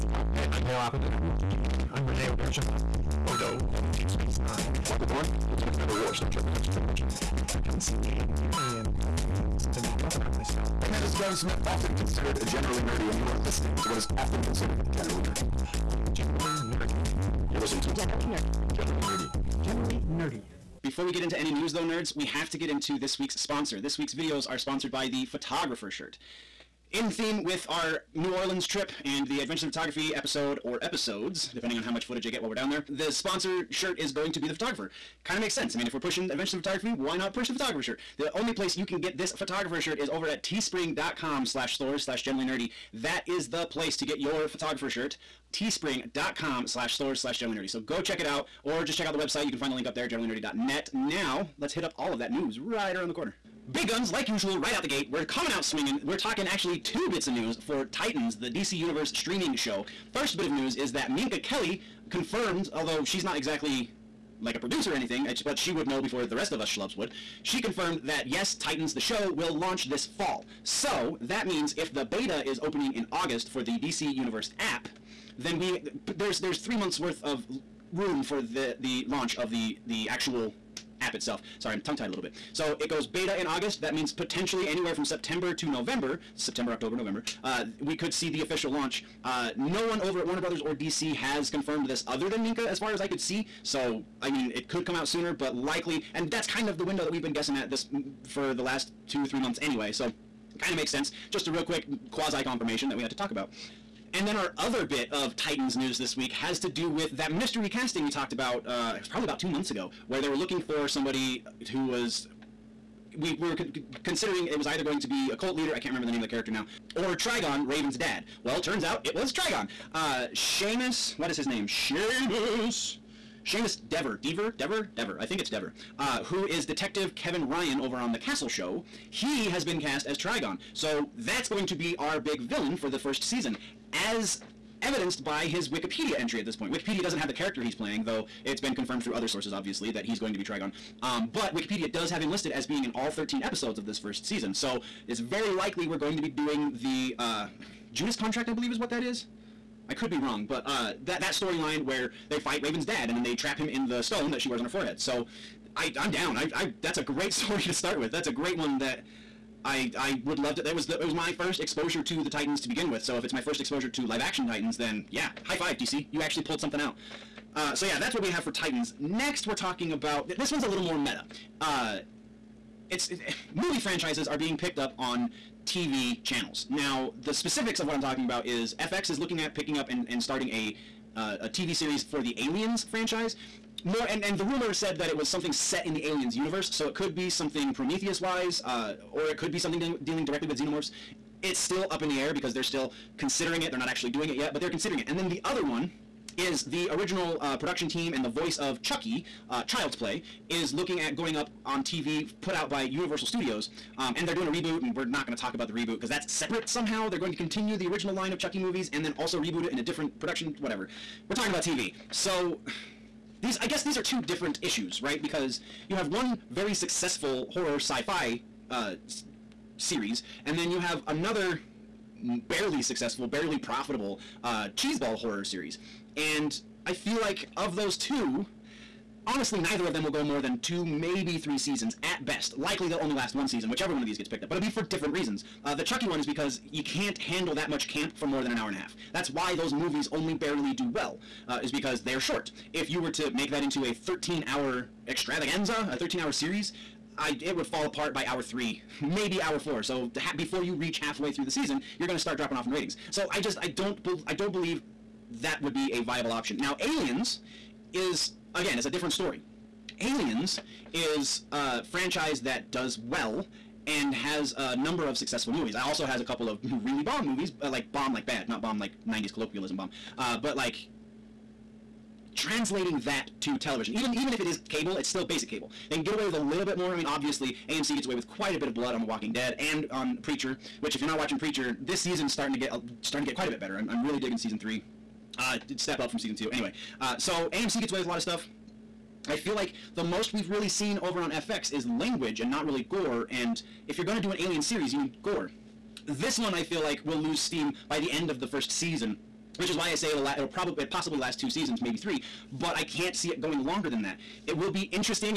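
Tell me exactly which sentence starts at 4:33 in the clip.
Even even if it is cable, it's still basic cable.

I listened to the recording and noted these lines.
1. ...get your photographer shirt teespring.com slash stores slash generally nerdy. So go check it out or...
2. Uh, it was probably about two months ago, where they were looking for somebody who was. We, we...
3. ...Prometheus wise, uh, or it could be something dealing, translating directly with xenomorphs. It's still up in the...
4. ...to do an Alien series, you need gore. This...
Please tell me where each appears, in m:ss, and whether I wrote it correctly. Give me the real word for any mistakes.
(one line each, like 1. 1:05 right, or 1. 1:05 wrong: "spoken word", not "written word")
1. 0:44 right
2. 1:48 right
3. 3:07 wrong: "dealing", not "translating"
4. 4:54 right.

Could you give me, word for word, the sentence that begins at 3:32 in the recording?
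So these I guess these are two different issues, right?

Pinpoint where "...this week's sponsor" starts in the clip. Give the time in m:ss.
0:22.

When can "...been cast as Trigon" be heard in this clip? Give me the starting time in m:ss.
2:09.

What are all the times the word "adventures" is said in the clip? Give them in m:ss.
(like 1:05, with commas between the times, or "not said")
0:29, 0:36.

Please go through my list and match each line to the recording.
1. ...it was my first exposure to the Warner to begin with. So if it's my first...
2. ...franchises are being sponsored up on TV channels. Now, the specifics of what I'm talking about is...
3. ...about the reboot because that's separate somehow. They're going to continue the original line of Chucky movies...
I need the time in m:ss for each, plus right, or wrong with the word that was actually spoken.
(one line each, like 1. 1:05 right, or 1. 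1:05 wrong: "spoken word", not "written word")
1. 2:41 wrong: "Titans", not "Warner"
2. 2:53 wrong: "picked", not "sponsored"
3. 3:25 right.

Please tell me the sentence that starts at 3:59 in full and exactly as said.
That's why those movies only barely do well, uh, is because they're short.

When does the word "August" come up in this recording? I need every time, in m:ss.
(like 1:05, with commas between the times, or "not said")
1:13, 1:23.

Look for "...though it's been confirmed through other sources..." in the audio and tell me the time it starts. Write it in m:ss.
2:18.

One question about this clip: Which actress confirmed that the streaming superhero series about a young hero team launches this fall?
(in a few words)
Minka Kelly.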